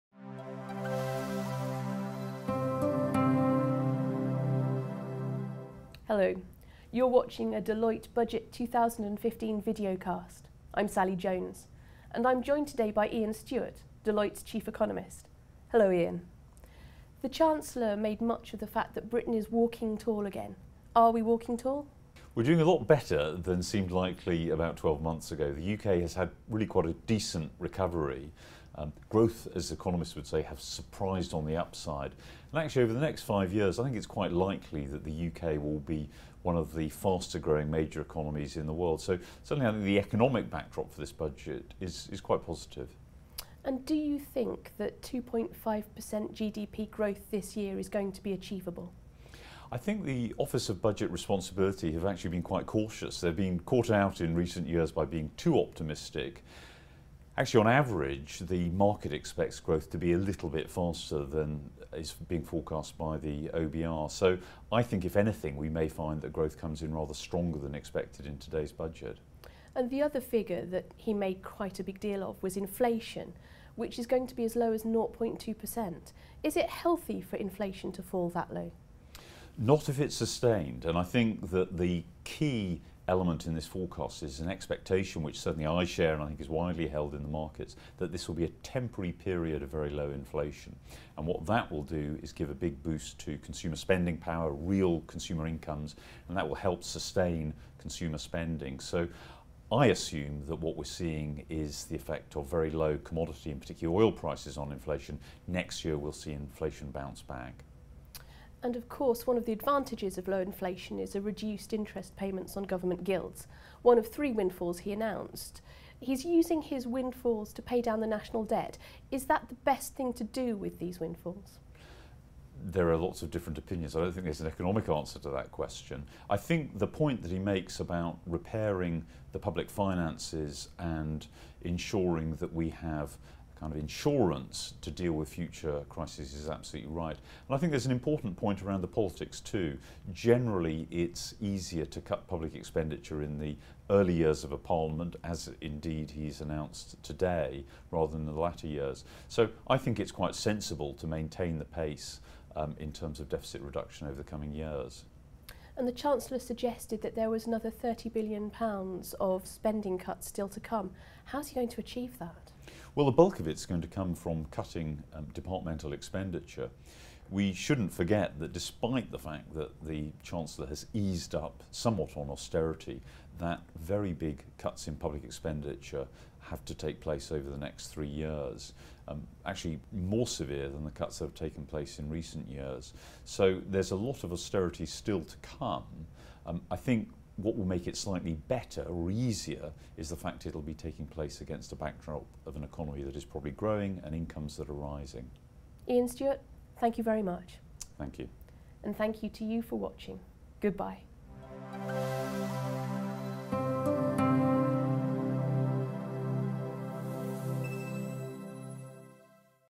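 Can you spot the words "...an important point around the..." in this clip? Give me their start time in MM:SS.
02:17.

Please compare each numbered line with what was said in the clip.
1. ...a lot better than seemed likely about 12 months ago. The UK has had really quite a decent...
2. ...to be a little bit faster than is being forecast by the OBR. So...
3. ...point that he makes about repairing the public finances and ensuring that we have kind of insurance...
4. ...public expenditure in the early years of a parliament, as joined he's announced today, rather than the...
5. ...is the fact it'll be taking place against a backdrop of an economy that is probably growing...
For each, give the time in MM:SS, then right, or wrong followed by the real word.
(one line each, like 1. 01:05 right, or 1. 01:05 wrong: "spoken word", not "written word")
1. 00:22 right
2. 00:59 right
3. 02:06 right
4. 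02:22 wrong: "indeed", not "joined"
5. 03:09 right.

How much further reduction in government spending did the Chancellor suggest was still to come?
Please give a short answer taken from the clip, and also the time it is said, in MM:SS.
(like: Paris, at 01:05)
£30 billion, at 02:37.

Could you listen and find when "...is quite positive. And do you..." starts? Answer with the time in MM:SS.
00:42.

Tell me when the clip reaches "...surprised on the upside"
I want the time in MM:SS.
00:30.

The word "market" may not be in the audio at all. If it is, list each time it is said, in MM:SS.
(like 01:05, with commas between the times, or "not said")
00:58, 01:27.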